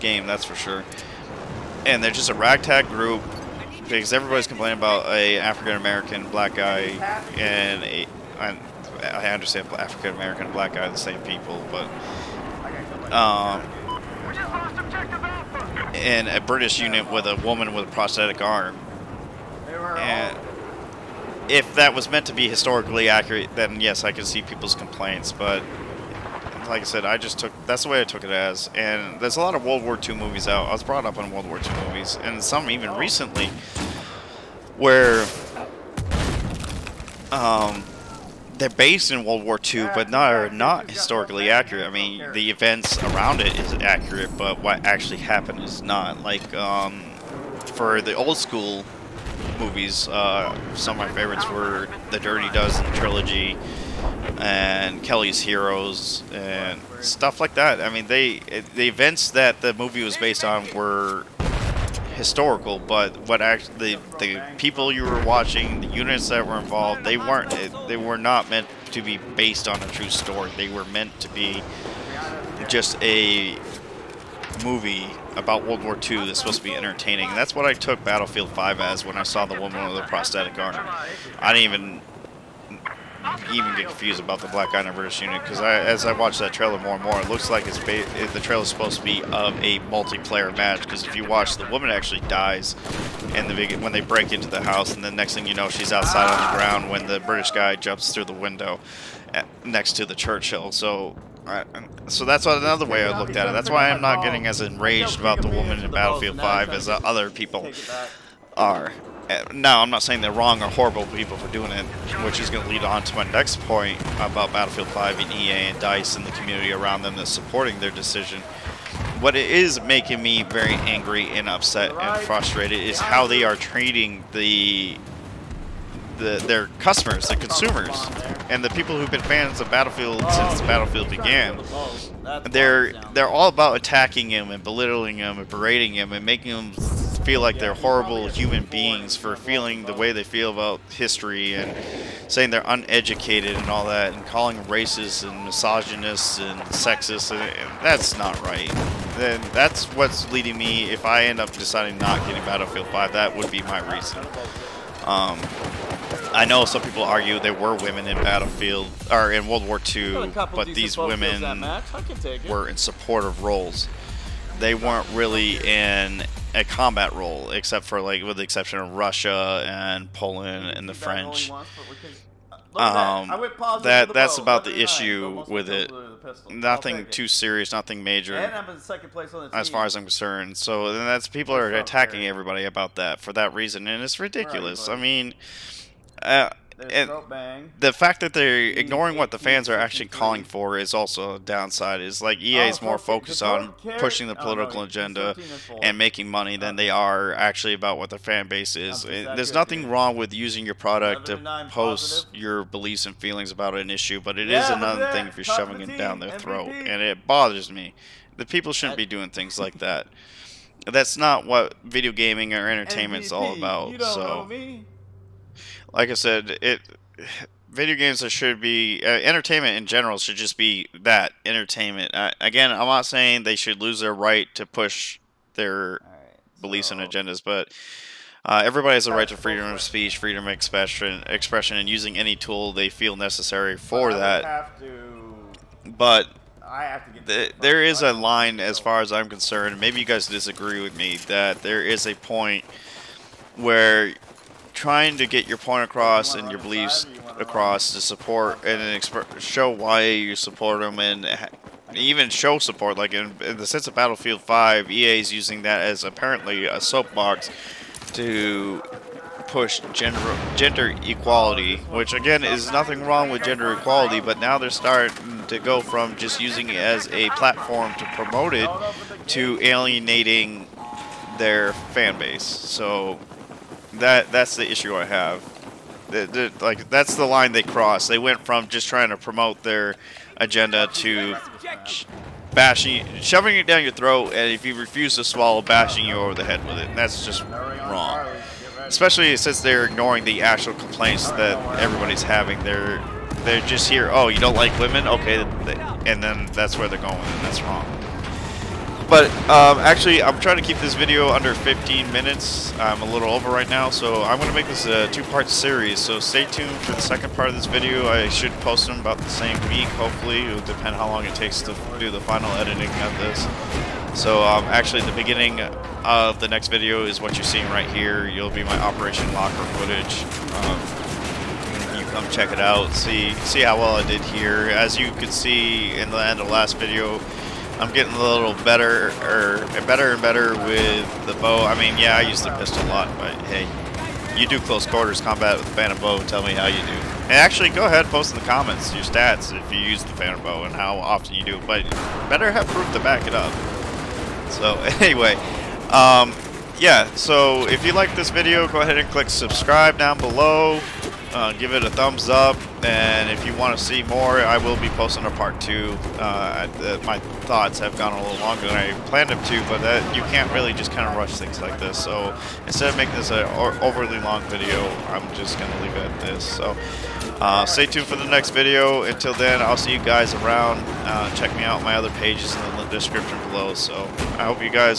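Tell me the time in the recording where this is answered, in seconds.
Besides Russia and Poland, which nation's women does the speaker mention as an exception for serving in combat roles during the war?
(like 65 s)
170 s.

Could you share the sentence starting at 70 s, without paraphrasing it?
They were meant to be just a movie about World War II that's supposed to be entertaining.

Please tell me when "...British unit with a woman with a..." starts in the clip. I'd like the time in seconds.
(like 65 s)
16 s.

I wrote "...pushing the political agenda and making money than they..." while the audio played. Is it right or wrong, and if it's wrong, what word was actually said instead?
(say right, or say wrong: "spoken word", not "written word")
right.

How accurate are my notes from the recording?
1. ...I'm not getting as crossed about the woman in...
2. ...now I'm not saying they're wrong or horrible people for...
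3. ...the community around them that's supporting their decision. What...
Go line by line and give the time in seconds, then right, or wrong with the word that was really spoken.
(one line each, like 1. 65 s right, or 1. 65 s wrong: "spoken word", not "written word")
1. 103 s wrong: "enraged", not "crossed"
2. 109 s right
3. 116 s right.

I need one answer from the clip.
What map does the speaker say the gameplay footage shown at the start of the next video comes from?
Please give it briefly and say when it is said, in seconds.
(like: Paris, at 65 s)
Operation Locker, at 318 s.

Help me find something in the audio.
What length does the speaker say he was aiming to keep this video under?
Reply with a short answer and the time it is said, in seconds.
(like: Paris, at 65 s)
15 minutes, at 301 s.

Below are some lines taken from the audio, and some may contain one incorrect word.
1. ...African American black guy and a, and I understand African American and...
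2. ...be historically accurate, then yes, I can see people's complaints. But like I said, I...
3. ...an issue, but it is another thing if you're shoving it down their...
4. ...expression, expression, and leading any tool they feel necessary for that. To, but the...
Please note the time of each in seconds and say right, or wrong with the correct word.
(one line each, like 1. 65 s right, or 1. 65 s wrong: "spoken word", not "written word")
1. 5 s right
2. 22 s right
3. 203 s right
4. 230 s wrong: "using", not "leading".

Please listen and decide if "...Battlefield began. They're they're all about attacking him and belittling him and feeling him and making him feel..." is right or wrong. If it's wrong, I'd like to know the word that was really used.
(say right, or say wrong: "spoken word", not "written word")
wrong: "berating", not "feeling".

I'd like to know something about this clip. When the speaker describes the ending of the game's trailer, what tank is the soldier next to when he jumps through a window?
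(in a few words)
Churchill.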